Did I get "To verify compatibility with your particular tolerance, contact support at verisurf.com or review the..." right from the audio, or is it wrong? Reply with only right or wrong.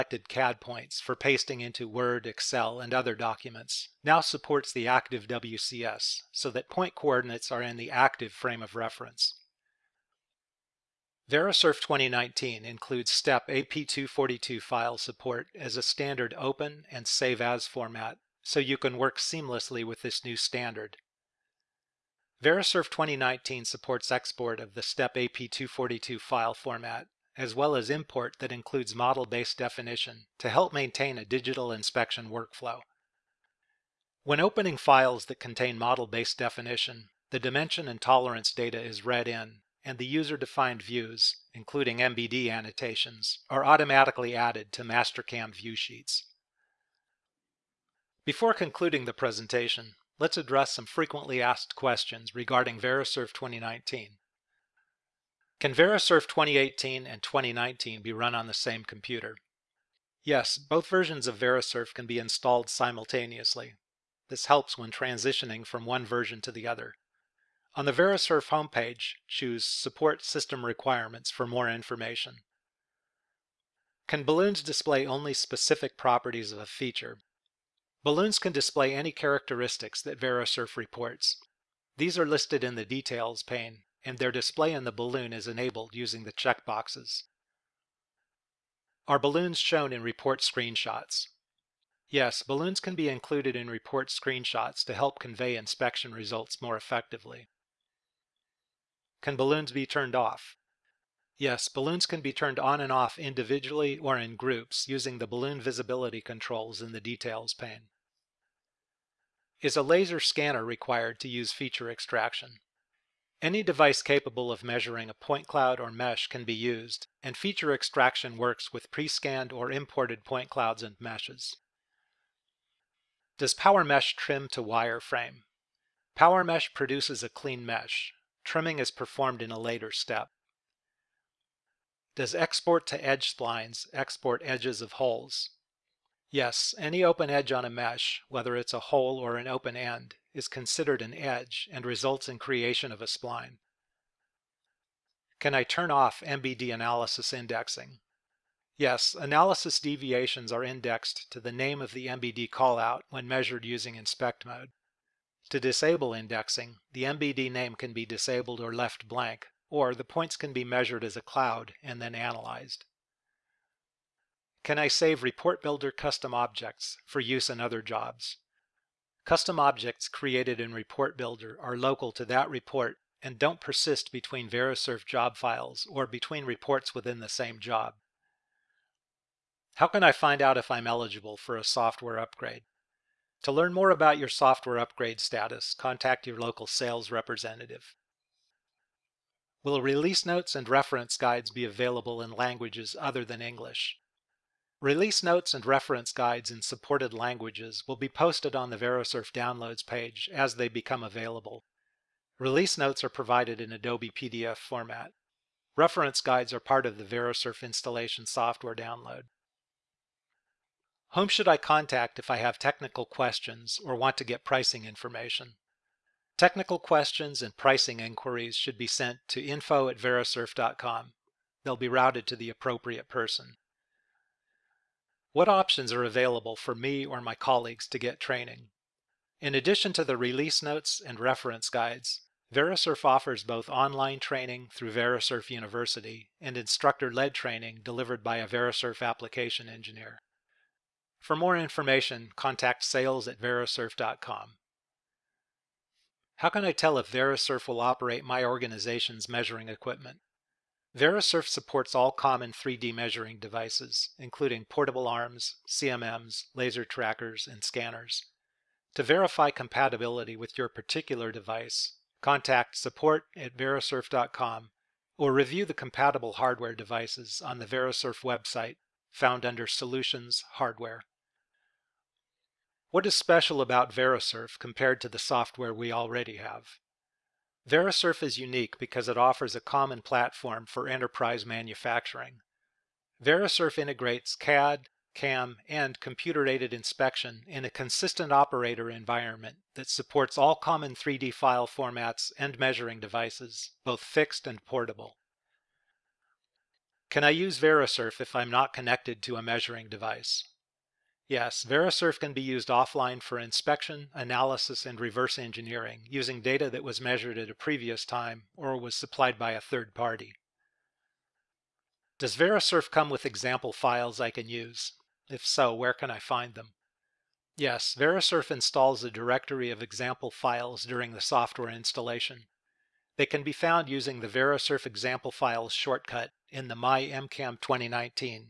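wrong.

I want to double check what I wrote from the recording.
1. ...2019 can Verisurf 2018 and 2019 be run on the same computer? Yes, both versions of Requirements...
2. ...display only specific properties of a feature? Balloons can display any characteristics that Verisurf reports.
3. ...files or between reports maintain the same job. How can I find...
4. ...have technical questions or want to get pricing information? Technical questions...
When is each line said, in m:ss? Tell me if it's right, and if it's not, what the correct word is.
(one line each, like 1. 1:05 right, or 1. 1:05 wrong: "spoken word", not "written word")
1. 0:53 wrong: "Verisurf", not "Requirements"
2. 1:14 right
3. 2:55 wrong: "within", not "maintain"
4. 3:32 right.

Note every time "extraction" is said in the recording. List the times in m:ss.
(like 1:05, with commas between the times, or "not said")
1:51, 1:57.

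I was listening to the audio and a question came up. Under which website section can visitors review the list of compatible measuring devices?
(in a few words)
Solutions Hardware.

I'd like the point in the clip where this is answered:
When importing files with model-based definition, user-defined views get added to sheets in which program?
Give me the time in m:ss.
0:44.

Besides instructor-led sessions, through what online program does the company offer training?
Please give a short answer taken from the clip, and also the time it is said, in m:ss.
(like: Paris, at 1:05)
Verisurf University, at 3:54.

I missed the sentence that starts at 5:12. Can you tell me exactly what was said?
Does Verisurf come with example files I can use?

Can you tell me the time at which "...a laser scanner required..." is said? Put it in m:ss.
1:49.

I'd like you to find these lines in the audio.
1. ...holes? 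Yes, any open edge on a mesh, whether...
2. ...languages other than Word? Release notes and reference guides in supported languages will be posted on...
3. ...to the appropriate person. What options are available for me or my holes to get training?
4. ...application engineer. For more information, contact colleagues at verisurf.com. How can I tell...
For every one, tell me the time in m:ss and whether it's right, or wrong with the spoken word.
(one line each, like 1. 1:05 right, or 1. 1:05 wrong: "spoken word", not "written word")
1. 2:14 right
2. 3:12 wrong: "English", not "Word"
3. 3:42 wrong: "colleagues", not "holes"
4. 3:59 wrong: "sales", not "colleagues".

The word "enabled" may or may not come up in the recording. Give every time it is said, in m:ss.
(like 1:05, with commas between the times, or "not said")
1:25.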